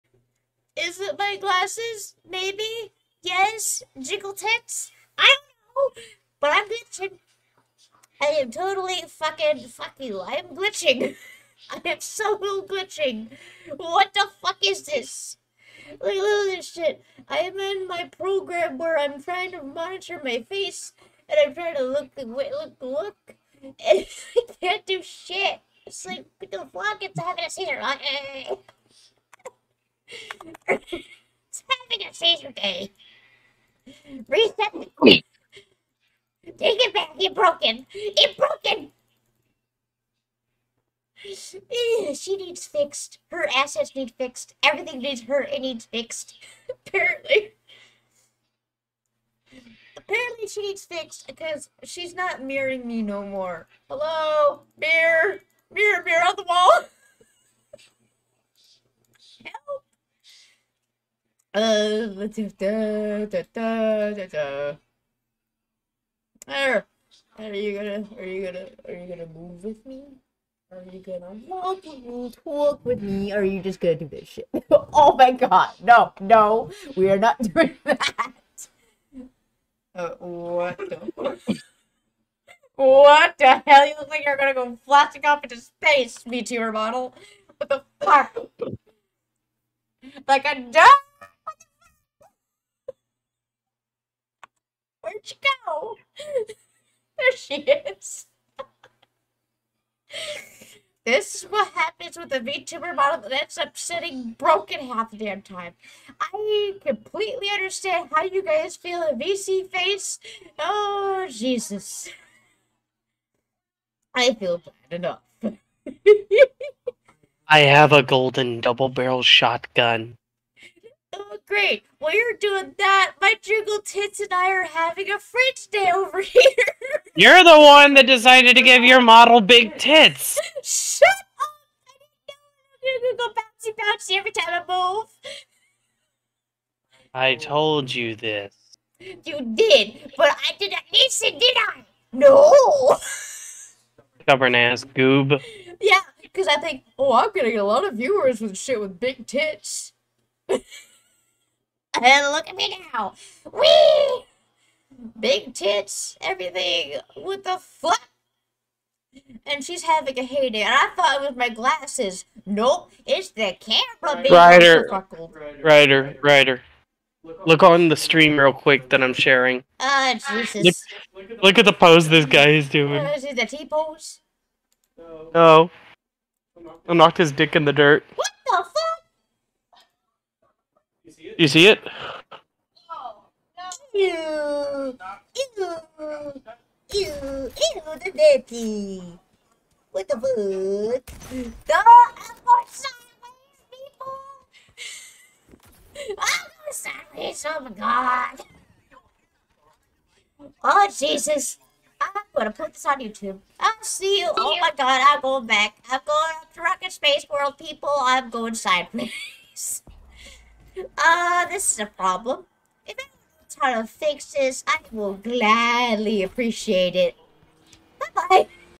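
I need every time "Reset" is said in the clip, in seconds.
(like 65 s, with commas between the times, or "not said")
34 s.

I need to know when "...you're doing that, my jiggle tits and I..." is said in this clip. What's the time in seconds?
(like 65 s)
122 s.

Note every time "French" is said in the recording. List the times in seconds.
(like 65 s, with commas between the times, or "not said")
125 s.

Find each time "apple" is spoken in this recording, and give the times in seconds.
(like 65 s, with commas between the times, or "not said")
191 s, 196 s.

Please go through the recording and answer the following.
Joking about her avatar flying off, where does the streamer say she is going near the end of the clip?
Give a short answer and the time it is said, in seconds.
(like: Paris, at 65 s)
Rocket Space World, at 206 s.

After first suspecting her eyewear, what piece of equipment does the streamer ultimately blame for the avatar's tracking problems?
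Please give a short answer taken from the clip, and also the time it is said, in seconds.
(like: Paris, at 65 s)
the camera, at 163 s.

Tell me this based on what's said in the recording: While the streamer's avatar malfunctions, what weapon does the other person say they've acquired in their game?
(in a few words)
golden double barrel shotgun.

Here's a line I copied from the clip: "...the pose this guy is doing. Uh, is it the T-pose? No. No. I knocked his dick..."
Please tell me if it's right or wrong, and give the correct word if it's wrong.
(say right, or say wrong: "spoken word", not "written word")
right.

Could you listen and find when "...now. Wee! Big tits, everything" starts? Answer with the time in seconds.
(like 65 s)
152 s.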